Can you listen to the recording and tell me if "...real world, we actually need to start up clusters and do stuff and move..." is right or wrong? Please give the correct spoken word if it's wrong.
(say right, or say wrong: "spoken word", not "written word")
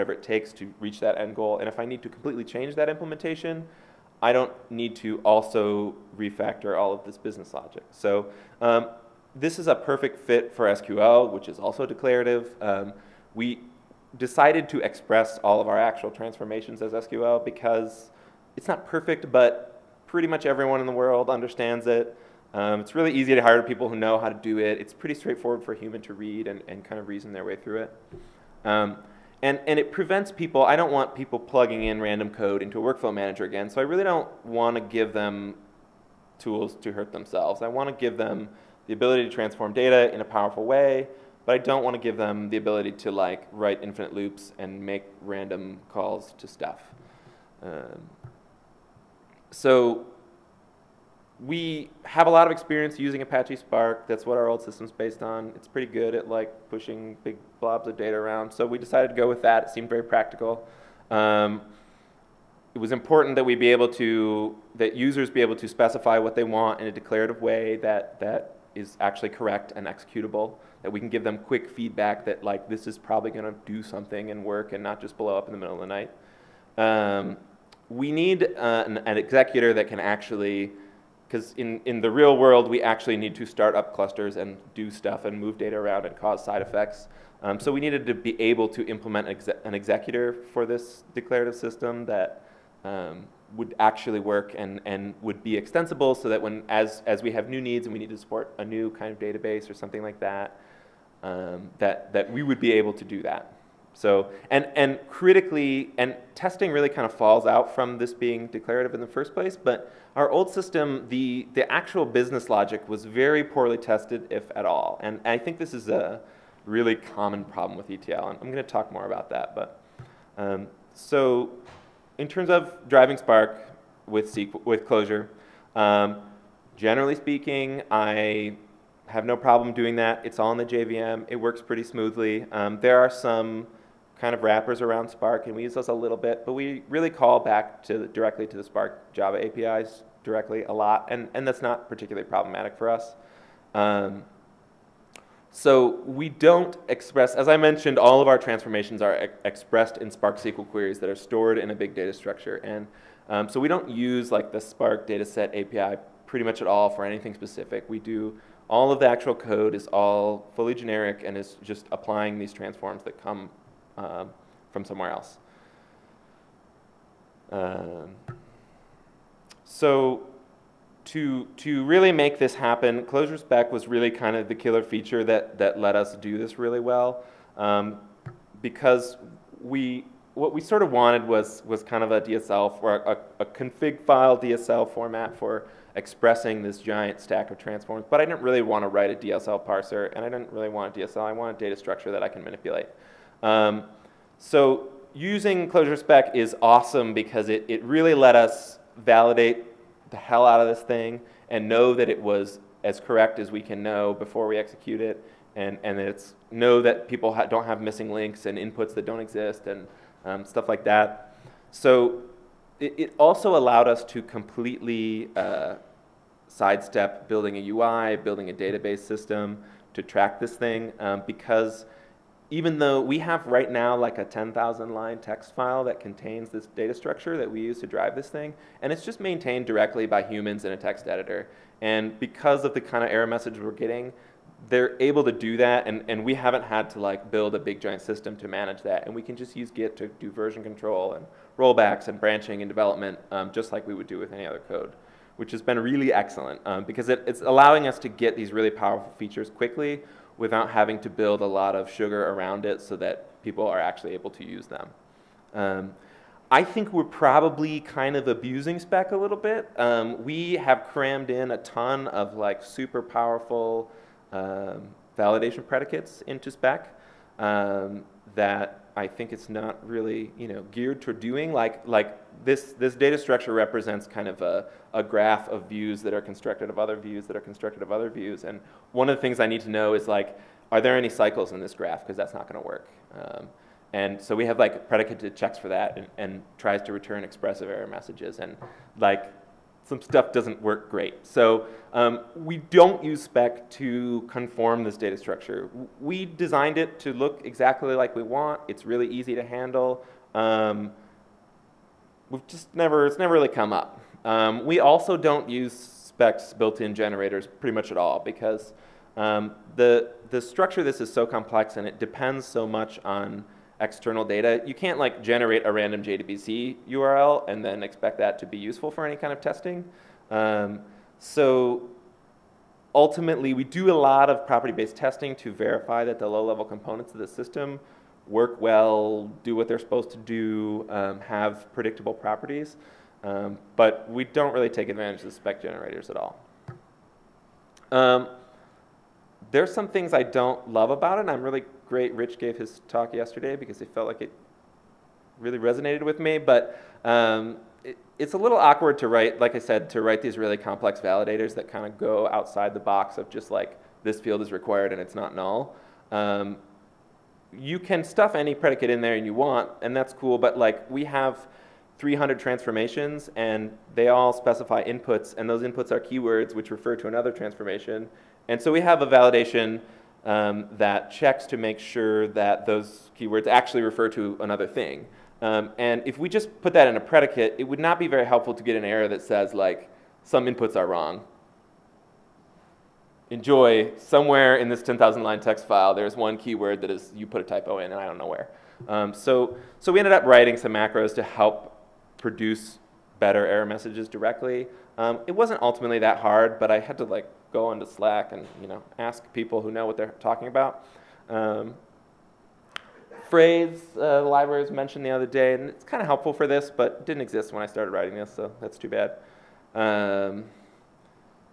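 right.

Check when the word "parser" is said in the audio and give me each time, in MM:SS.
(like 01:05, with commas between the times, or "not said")
03:09.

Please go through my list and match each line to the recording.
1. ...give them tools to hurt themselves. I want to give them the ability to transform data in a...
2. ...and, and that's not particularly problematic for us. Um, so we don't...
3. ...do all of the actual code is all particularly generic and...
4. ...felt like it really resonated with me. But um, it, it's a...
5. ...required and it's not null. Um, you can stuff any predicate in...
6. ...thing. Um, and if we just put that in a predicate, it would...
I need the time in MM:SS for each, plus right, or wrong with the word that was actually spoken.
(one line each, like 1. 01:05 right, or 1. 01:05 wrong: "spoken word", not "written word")
1. 00:34 right
2. 02:21 right
3. 02:37 wrong: "fully", not "particularly"
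4. 05:43 right
5. 05:54 right
6. 06:14 right.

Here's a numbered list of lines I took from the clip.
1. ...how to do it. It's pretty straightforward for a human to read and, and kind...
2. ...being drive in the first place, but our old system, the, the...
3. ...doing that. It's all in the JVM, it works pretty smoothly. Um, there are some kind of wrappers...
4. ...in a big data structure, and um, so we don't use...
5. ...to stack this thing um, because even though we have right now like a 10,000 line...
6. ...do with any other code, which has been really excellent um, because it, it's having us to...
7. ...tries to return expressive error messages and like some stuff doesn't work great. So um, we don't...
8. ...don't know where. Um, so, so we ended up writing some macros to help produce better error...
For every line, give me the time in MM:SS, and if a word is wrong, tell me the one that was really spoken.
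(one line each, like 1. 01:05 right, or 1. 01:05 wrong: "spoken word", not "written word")
1. 00:24 right
2. 01:48 wrong: "declarative", not "drive"
3. 02:09 right
4. 02:31 right
5. 03:39 wrong: "track", not "stack"
6. 04:04 wrong: "allowing", not "having"
7. 04:46 right
8. 06:28 right.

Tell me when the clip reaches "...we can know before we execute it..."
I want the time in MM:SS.
03:23.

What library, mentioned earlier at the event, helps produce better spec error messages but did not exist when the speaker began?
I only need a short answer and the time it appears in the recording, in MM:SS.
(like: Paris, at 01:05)
phrase, at 06:43.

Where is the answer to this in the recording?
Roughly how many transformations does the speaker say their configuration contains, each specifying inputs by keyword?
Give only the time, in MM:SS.
06:01.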